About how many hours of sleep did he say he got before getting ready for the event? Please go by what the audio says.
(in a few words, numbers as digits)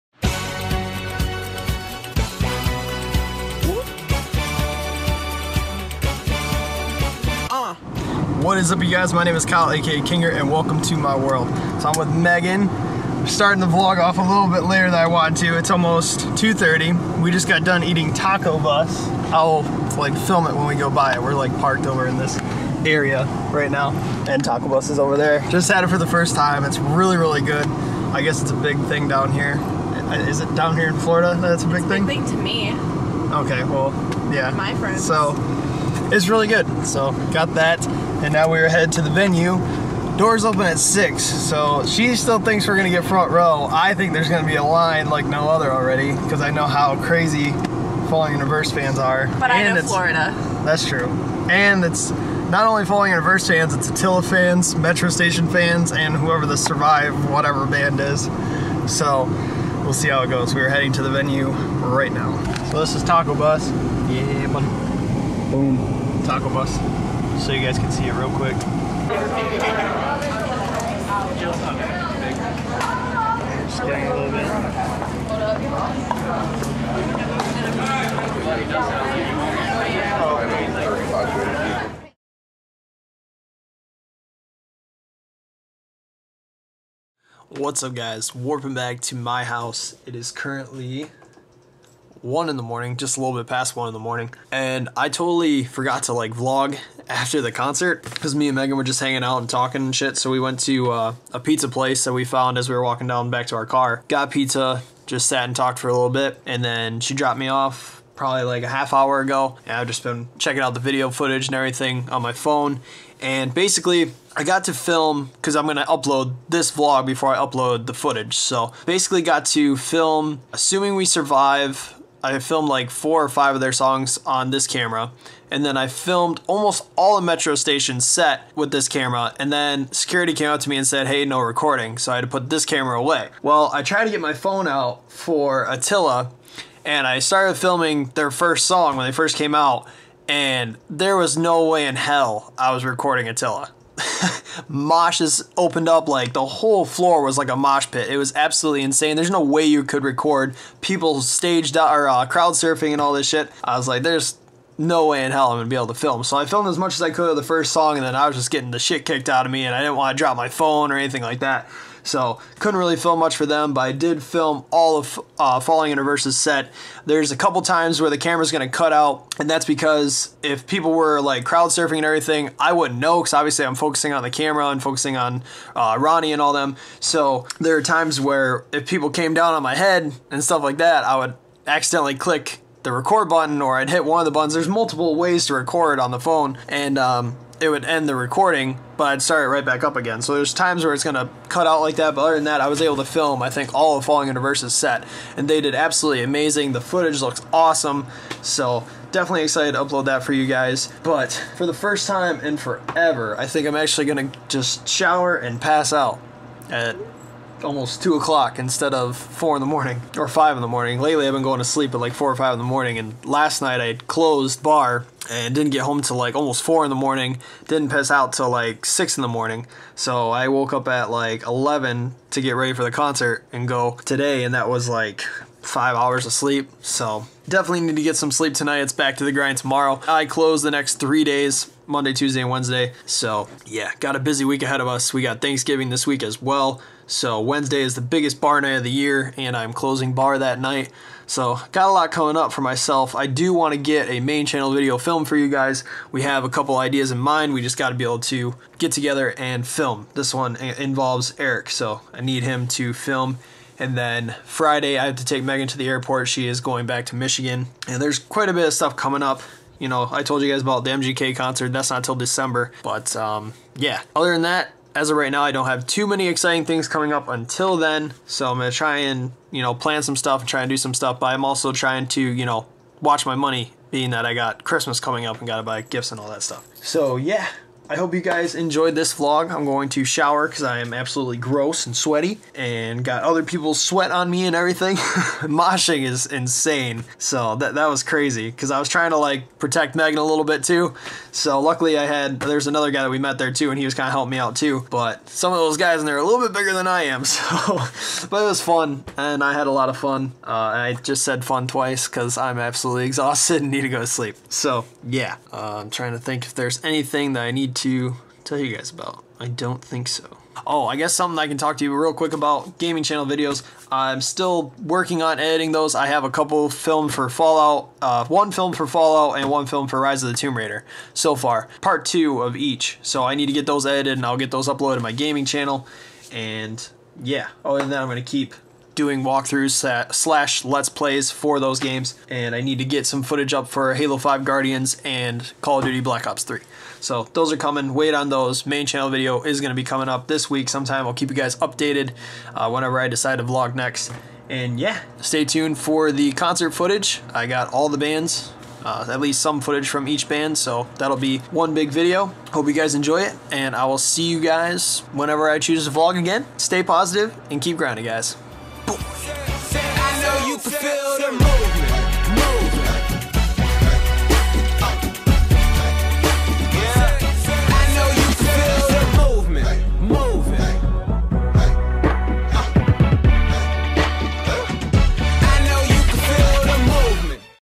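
5.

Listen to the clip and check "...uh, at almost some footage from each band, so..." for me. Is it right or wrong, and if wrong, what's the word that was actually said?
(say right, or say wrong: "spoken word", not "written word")
wrong: "least", not "almost".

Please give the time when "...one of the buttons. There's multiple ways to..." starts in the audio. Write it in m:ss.
3:04.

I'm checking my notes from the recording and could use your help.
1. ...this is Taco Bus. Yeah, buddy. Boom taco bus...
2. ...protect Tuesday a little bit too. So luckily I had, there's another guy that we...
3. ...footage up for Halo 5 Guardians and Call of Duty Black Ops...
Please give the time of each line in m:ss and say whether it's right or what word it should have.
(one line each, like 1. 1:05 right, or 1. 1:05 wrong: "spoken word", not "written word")
1. 1:02 right
2. 4:49 wrong: "Megan", not "Tuesday"
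3. 5:33 right.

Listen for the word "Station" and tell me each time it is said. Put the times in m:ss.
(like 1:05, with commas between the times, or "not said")
0:55, 2:07.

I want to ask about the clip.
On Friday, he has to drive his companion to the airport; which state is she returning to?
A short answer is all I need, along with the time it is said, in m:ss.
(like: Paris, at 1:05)
Michigan, at 4:17.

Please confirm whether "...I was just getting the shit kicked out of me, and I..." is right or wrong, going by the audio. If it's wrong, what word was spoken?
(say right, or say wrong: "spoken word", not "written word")
right.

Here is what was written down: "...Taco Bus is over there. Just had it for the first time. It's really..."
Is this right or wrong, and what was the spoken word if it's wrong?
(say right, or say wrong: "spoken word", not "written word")
right.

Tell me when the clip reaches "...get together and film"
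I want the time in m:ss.
4:08.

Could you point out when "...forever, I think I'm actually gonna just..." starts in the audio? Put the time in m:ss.
3:22.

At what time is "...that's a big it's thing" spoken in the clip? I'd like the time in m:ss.
0:31.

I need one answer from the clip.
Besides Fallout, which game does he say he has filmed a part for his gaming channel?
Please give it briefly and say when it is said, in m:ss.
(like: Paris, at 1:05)
Rise of the Tomb Raider, at 5:19.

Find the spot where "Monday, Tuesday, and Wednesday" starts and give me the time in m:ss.
3:51.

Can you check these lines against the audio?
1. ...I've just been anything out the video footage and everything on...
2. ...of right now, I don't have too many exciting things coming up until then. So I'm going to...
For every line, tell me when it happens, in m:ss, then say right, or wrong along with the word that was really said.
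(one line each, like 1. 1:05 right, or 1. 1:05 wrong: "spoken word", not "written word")
1. 1:49 wrong: "checking", not "anything"
2. 4:25 right.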